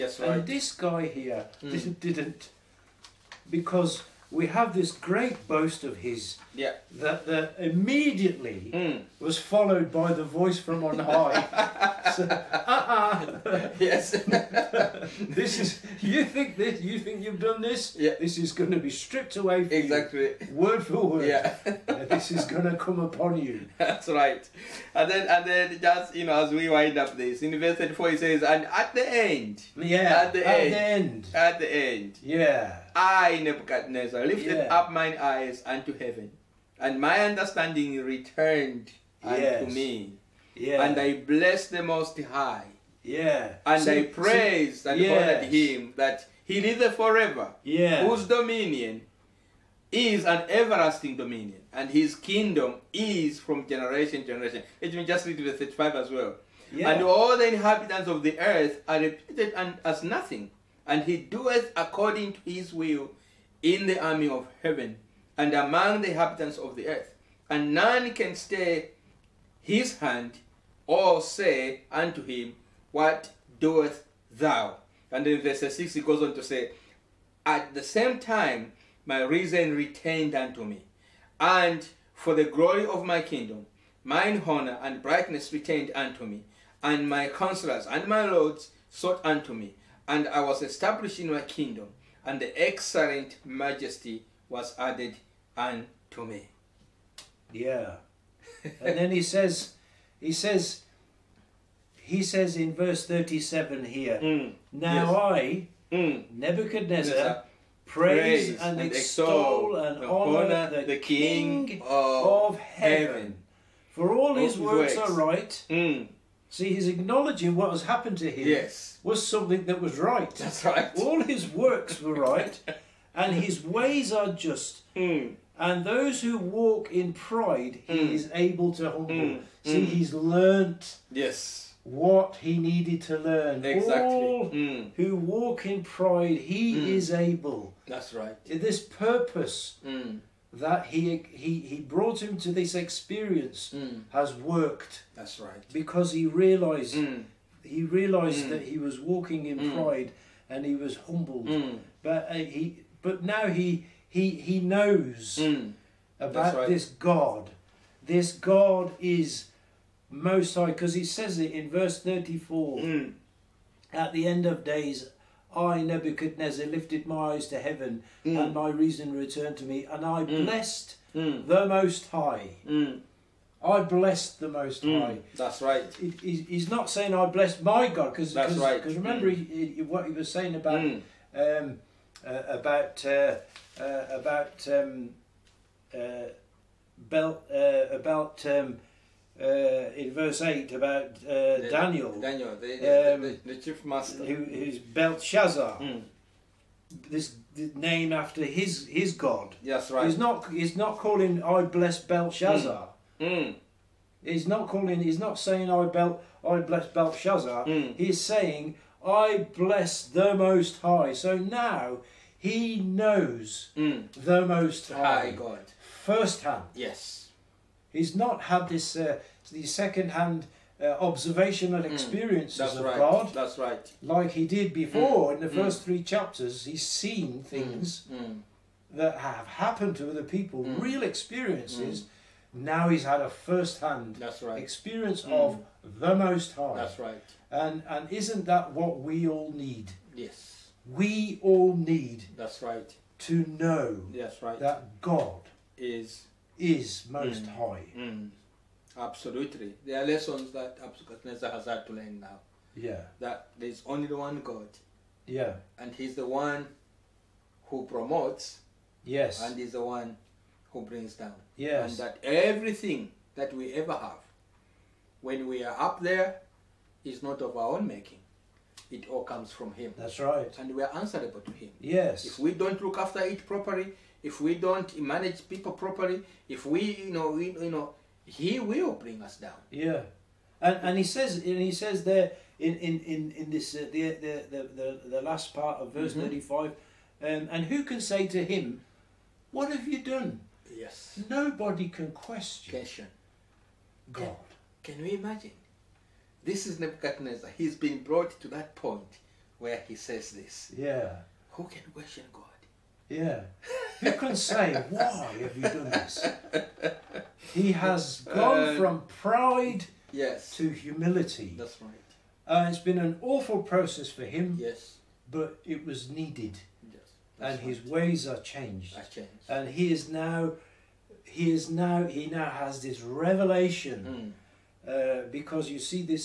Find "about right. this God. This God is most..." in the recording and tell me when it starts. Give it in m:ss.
2:36.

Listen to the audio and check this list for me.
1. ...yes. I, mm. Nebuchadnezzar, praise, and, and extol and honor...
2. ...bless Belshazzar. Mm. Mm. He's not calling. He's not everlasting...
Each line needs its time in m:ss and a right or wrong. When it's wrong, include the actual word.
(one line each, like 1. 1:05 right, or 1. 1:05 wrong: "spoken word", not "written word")
1. 1:45 right
2. 3:21 wrong: "saying", not "everlasting".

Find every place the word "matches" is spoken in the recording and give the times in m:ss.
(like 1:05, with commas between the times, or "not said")
not said.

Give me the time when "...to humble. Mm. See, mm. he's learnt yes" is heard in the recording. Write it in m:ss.
2:08.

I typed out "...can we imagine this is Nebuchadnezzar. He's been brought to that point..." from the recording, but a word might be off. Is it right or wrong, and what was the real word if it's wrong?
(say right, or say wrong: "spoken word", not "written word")
right.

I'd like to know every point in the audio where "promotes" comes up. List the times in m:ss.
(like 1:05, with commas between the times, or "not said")
4:17.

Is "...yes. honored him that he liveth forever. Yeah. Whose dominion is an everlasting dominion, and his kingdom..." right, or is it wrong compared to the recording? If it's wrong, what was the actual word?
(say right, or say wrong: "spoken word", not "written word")
right.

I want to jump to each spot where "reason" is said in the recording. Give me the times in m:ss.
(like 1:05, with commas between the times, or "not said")
1:19, 2:48.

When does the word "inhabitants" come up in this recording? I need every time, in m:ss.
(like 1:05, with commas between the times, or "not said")
0:57, 1:06.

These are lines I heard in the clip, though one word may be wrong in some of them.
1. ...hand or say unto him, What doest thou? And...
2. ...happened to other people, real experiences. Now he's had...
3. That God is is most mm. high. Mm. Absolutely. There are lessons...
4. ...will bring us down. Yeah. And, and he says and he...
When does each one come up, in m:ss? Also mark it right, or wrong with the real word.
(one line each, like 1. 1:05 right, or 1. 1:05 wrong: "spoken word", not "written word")
1. 1:09 right
2. 3:49 right
3. 4:04 right
4. 4:38 right.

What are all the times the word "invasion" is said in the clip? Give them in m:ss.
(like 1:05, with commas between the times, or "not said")
not said.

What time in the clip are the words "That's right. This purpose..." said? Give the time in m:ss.
2:17.